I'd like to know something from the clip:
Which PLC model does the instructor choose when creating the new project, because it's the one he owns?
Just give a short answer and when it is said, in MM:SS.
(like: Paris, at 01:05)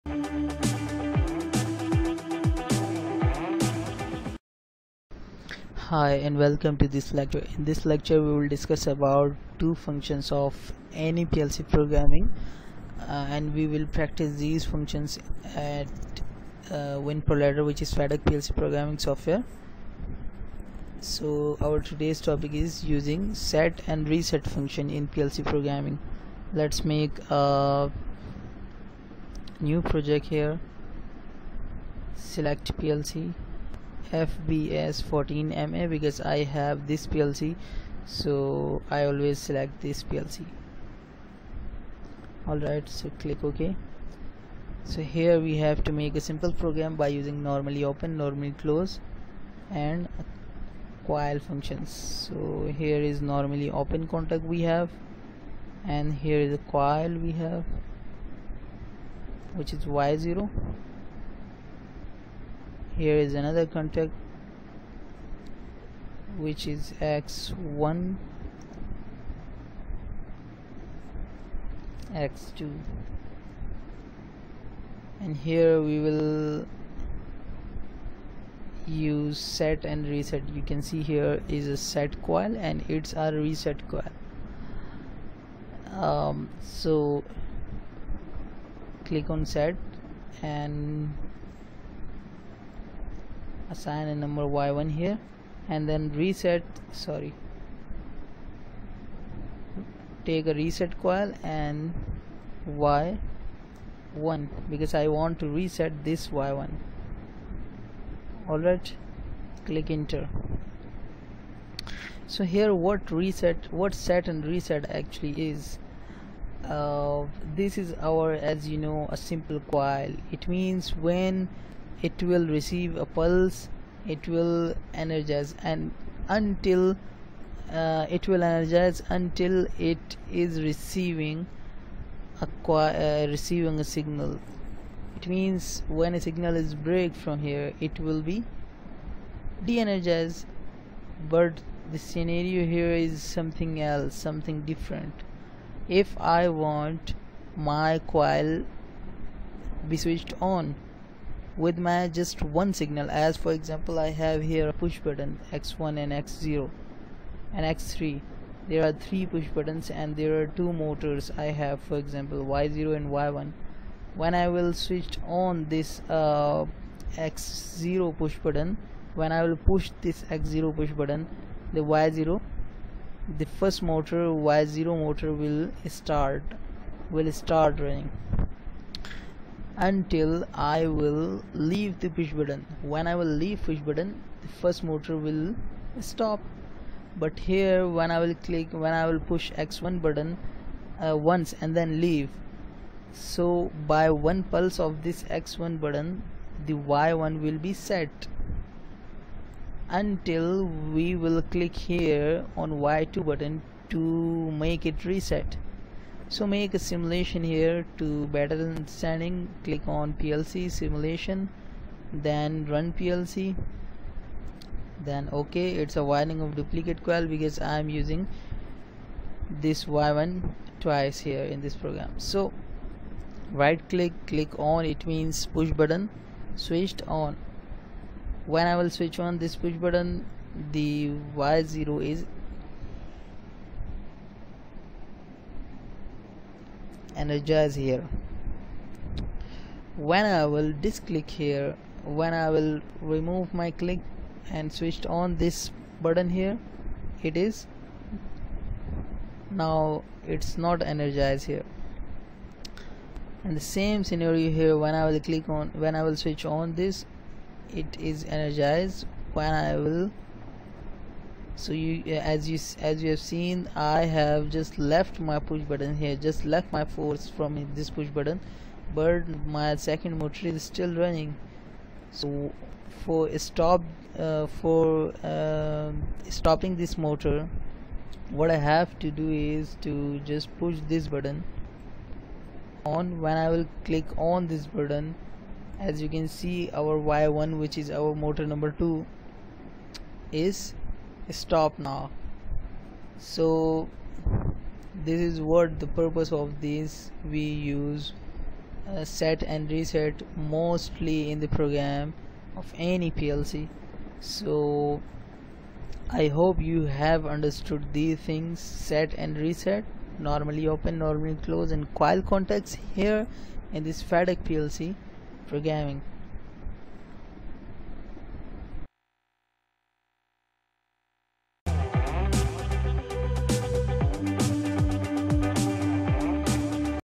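FBS14MA, at 00:34.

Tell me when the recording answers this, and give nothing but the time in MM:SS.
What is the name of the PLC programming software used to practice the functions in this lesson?
00:17.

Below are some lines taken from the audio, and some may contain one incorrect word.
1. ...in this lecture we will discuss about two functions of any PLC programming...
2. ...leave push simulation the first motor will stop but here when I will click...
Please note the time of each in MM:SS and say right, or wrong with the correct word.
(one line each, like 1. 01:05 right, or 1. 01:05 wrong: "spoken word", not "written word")
1. 00:07 right
2. 03:03 wrong: "button", not "simulation".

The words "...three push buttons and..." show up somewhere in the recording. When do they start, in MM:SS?
02:38.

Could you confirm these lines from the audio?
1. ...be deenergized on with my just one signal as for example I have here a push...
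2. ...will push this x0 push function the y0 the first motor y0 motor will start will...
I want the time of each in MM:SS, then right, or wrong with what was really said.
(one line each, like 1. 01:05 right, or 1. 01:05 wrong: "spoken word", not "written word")
1. 02:29 wrong: "switched", not "deenergized"
2. 02:49 wrong: "button", not "function".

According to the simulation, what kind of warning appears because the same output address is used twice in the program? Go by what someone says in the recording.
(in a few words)
duplicate coil.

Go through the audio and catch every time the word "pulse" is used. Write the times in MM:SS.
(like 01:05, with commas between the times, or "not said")
02:03, 03:14.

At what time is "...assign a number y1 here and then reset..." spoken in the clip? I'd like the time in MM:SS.
01:33.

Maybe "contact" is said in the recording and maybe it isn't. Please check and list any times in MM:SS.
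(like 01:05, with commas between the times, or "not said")
00:54, 01:03, 05:12.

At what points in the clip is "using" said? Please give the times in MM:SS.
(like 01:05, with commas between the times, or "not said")
00:22, 00:47, 03:37.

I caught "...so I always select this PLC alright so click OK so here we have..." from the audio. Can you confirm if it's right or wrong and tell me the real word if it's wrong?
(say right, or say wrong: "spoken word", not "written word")
right.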